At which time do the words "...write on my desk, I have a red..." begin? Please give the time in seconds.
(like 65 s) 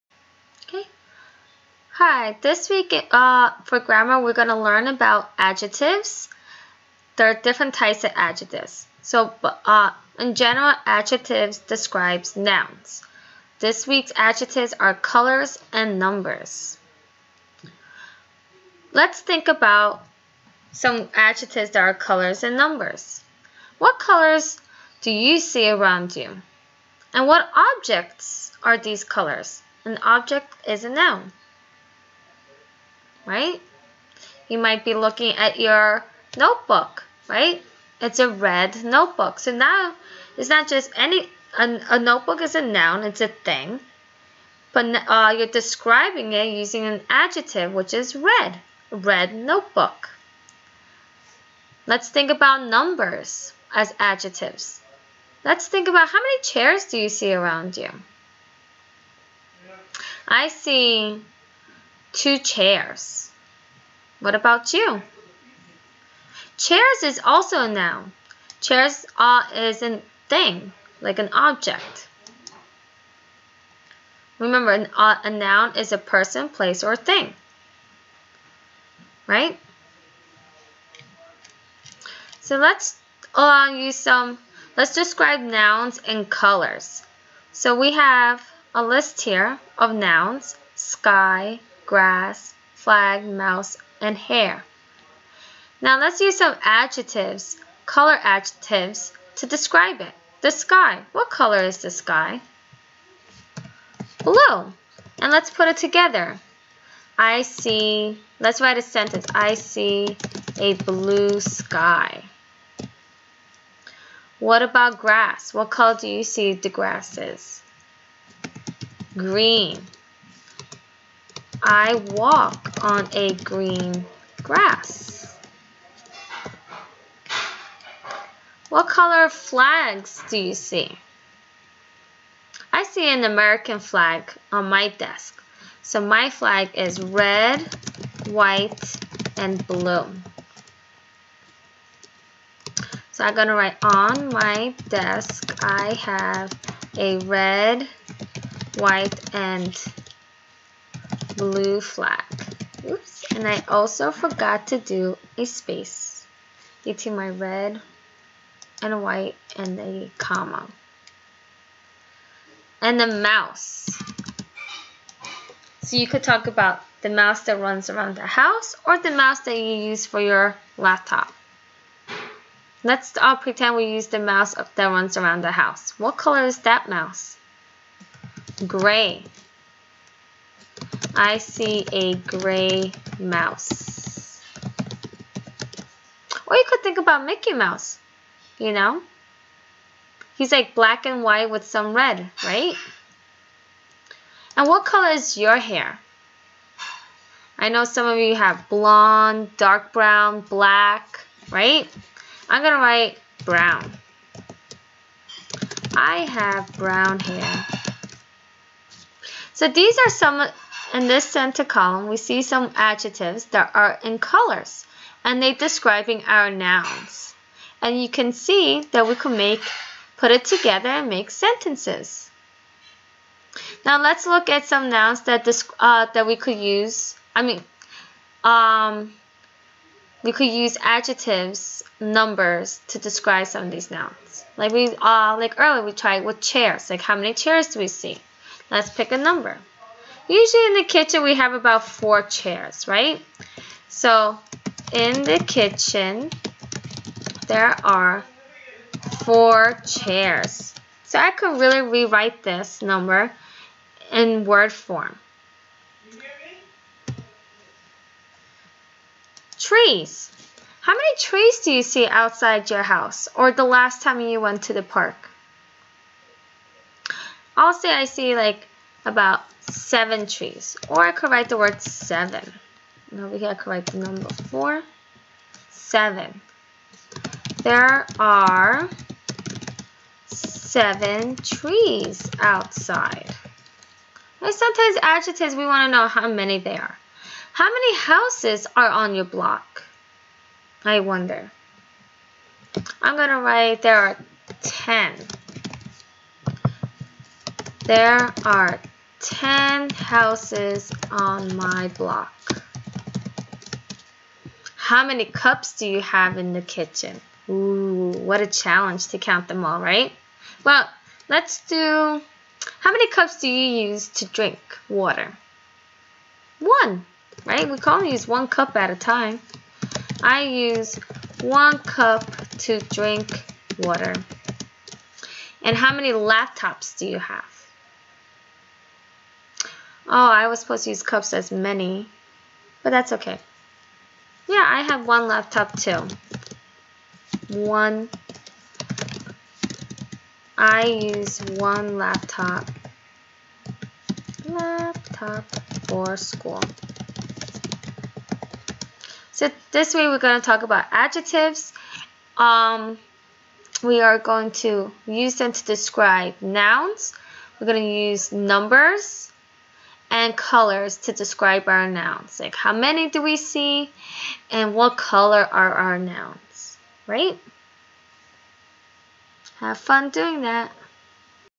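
143 s.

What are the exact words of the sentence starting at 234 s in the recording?
Like we uh, like earlier we tried with chairs, like how many chairs do we see?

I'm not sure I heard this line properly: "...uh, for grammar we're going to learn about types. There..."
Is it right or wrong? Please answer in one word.
wrong.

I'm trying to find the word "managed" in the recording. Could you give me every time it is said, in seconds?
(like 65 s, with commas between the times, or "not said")
not said.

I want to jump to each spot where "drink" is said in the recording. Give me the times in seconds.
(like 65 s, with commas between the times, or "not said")
314 s, 322 s.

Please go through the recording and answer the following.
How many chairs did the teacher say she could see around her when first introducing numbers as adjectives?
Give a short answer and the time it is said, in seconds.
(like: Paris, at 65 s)
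2, at 62 s.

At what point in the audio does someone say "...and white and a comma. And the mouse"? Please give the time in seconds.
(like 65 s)
158 s.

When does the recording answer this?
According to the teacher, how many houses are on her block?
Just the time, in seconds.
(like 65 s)
299 s.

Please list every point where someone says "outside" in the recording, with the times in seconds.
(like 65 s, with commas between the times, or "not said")
262 s, 282 s.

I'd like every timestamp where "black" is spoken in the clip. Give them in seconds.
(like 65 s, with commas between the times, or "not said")
190 s, 200 s.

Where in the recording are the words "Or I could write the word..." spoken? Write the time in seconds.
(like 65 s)
270 s.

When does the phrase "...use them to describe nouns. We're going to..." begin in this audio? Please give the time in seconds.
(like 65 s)
355 s.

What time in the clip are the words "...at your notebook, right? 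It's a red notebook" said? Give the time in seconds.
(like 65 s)
35 s.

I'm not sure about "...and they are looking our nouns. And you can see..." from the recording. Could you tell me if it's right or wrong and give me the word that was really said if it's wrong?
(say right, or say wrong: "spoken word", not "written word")
wrong: "describing", not "looking".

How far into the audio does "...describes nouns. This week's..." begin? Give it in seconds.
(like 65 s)
11 s.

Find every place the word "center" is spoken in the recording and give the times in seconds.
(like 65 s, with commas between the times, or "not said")
211 s.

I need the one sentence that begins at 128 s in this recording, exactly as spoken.
What color flags do you see?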